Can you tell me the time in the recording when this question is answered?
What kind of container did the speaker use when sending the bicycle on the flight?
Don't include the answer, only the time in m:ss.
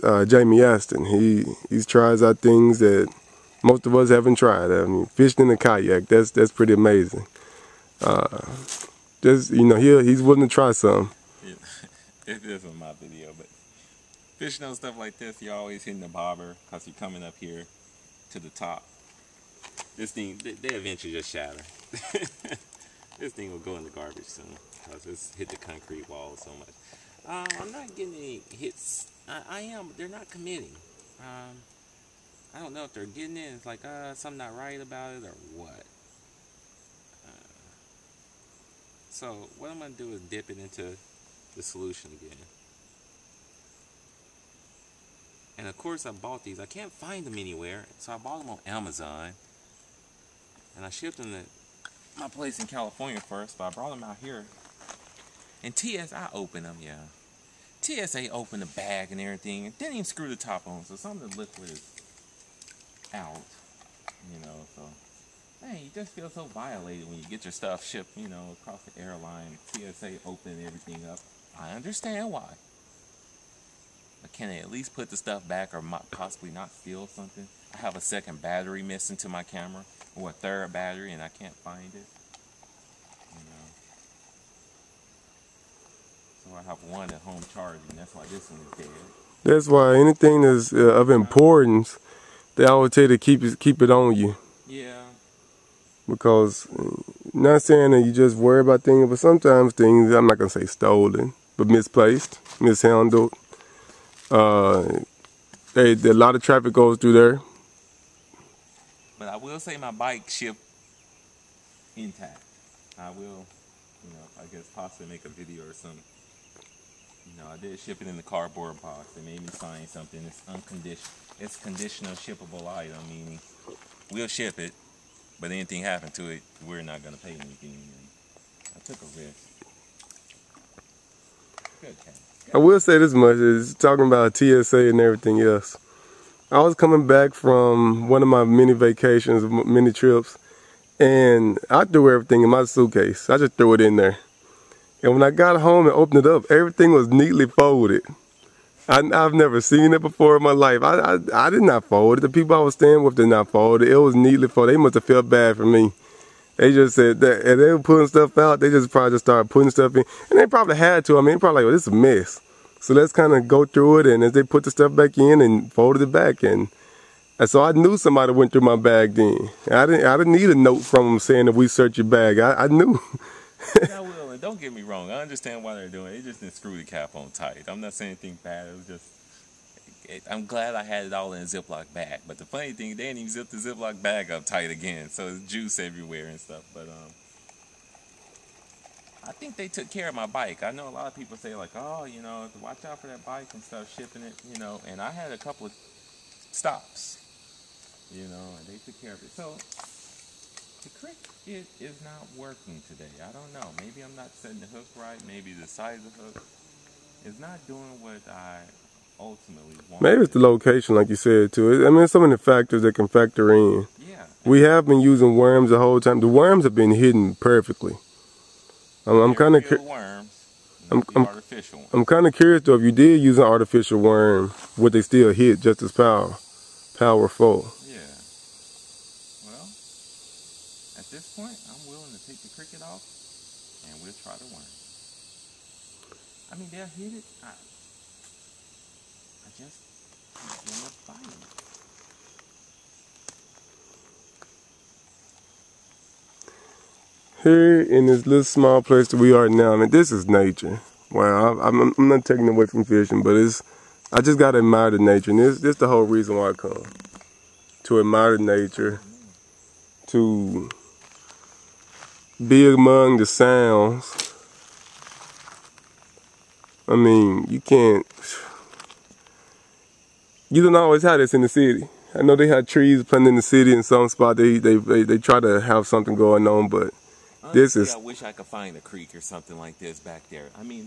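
1:58.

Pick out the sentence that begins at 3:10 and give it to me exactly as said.
I know a lot of people say like, oh, you know, watch out for that bike and stuff, shipping it, you know.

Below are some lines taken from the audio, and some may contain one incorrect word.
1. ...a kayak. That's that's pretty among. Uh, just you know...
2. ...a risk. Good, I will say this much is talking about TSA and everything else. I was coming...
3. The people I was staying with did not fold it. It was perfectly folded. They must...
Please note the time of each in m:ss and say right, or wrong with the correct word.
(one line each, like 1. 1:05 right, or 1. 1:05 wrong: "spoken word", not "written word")
1. 0:05 wrong: "amazing", not "among"
2. 2:08 right
3. 2:32 wrong: "neatly", not "perfectly".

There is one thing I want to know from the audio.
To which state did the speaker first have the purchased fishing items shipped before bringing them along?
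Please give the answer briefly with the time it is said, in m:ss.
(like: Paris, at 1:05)
California, at 0:52.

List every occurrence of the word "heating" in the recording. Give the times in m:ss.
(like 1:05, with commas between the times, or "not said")
not said.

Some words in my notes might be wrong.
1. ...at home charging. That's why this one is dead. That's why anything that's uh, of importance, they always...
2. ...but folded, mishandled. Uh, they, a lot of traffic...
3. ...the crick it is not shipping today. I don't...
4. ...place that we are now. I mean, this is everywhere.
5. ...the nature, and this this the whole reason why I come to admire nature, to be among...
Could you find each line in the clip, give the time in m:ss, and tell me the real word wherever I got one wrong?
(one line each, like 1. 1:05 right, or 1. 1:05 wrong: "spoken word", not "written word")
1. 1:27 right
2. 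1:41 wrong: "misplaced", not "folded"
3. 3:20 wrong: "working", not "shipping"
4. 4:08 wrong: "nature", not "everywhere"
5. 4:14 right.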